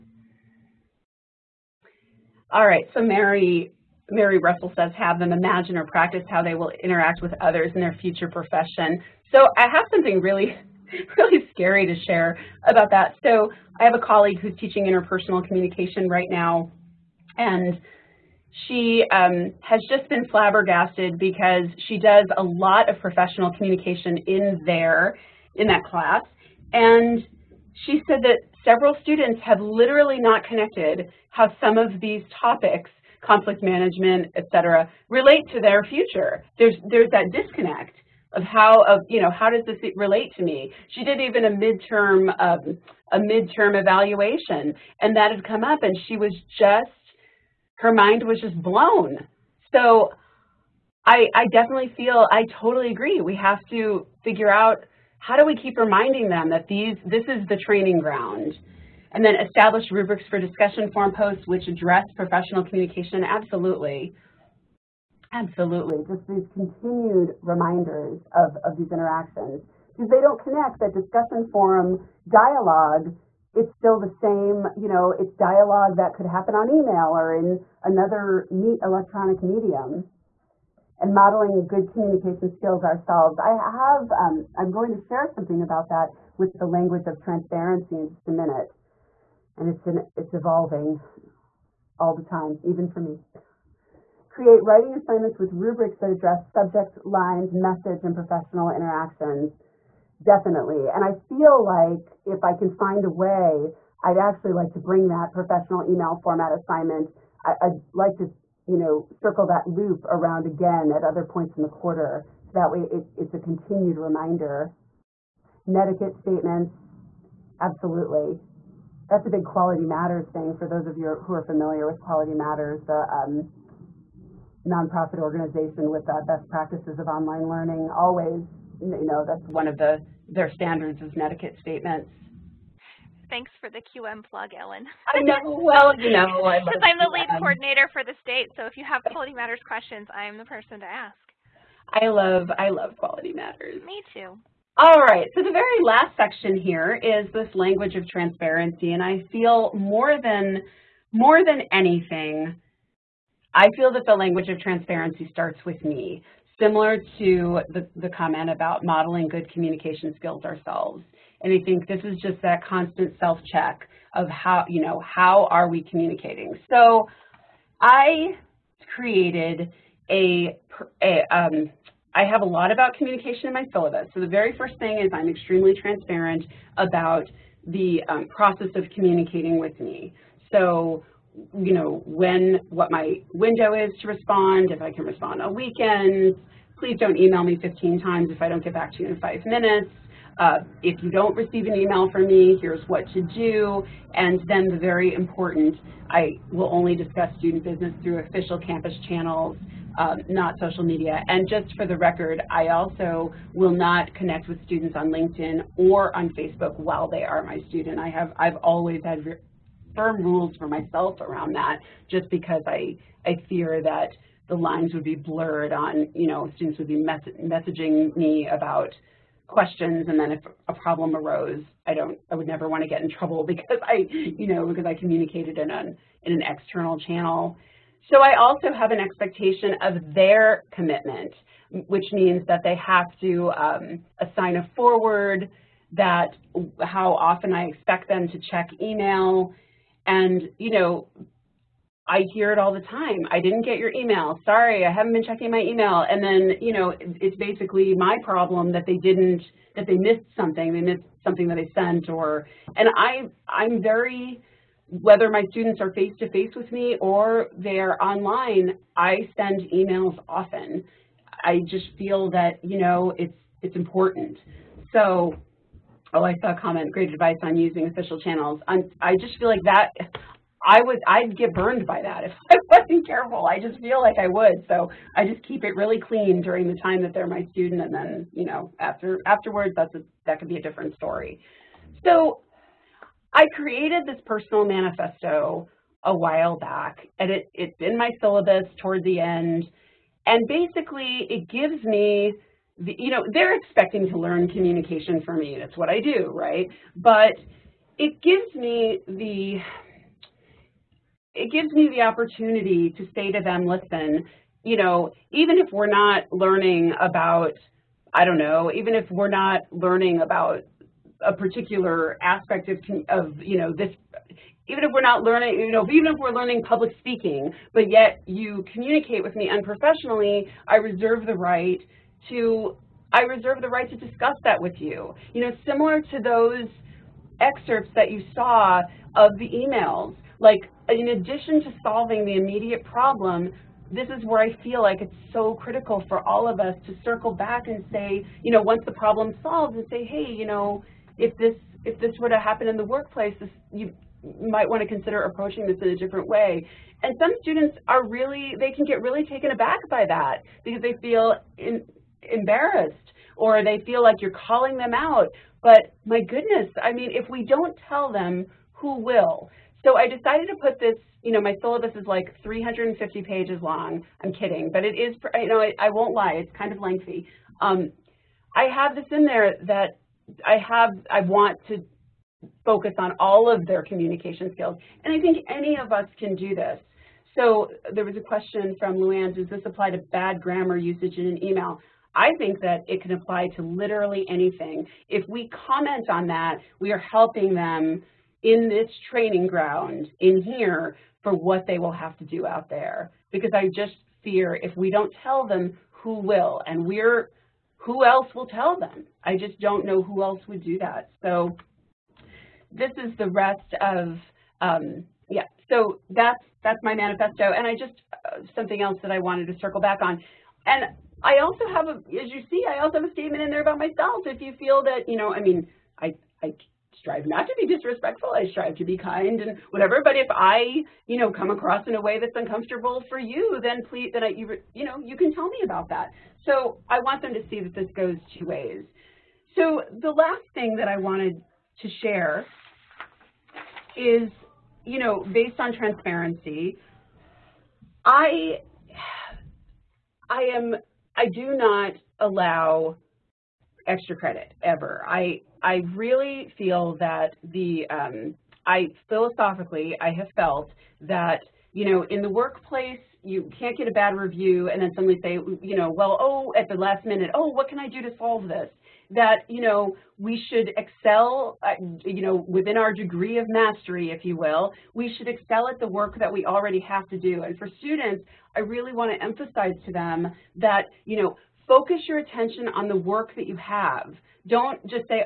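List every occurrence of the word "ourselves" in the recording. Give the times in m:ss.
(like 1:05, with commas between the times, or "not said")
1:22, 2:40.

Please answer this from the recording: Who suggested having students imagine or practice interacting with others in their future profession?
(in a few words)
Mary Russell.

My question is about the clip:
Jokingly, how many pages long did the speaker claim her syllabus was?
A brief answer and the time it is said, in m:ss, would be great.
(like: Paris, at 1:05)
350, at 6:02.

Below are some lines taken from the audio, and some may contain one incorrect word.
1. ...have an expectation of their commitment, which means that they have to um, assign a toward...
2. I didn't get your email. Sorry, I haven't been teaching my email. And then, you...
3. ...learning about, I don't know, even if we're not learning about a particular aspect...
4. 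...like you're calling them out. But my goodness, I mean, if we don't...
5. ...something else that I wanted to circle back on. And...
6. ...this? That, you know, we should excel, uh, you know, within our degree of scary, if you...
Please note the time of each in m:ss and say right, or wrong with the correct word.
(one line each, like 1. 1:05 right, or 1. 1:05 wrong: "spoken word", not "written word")
1. 3:48 wrong: "forward", not "toward"
2. 4:03 wrong: "checking", not "teaching"
3. 5:06 right
4. 5:54 right
5. 6:48 right
6. 7:38 wrong: "mastery", not "scary".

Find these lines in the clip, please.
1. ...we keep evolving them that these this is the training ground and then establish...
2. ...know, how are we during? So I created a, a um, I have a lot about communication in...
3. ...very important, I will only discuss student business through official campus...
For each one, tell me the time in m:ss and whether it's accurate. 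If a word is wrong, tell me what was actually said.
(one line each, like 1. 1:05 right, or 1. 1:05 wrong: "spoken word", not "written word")
1. 0:55 wrong: "reminding", not "evolving"
2. 2:44 wrong: "communicating", not "during"
3. 3:14 right.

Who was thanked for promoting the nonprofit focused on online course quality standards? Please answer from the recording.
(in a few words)
Ellen.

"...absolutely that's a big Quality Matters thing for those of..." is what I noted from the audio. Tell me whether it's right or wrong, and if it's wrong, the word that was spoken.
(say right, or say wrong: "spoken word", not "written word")
right.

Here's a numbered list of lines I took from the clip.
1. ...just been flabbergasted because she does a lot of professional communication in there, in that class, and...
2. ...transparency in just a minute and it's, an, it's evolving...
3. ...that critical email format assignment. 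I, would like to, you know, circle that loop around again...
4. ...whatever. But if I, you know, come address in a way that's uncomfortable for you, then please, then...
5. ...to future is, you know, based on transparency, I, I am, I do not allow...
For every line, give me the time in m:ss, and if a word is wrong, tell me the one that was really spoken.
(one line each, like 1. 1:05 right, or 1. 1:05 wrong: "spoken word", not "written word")
1. 0:19 right
2. 1:27 right
3. 1:45 wrong: "professional", not "critical"
4. 6:59 wrong: "across", not "address"
5. 7:11 wrong: "share", not "future".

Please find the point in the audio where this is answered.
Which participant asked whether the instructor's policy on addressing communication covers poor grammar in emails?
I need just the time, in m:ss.
6:18.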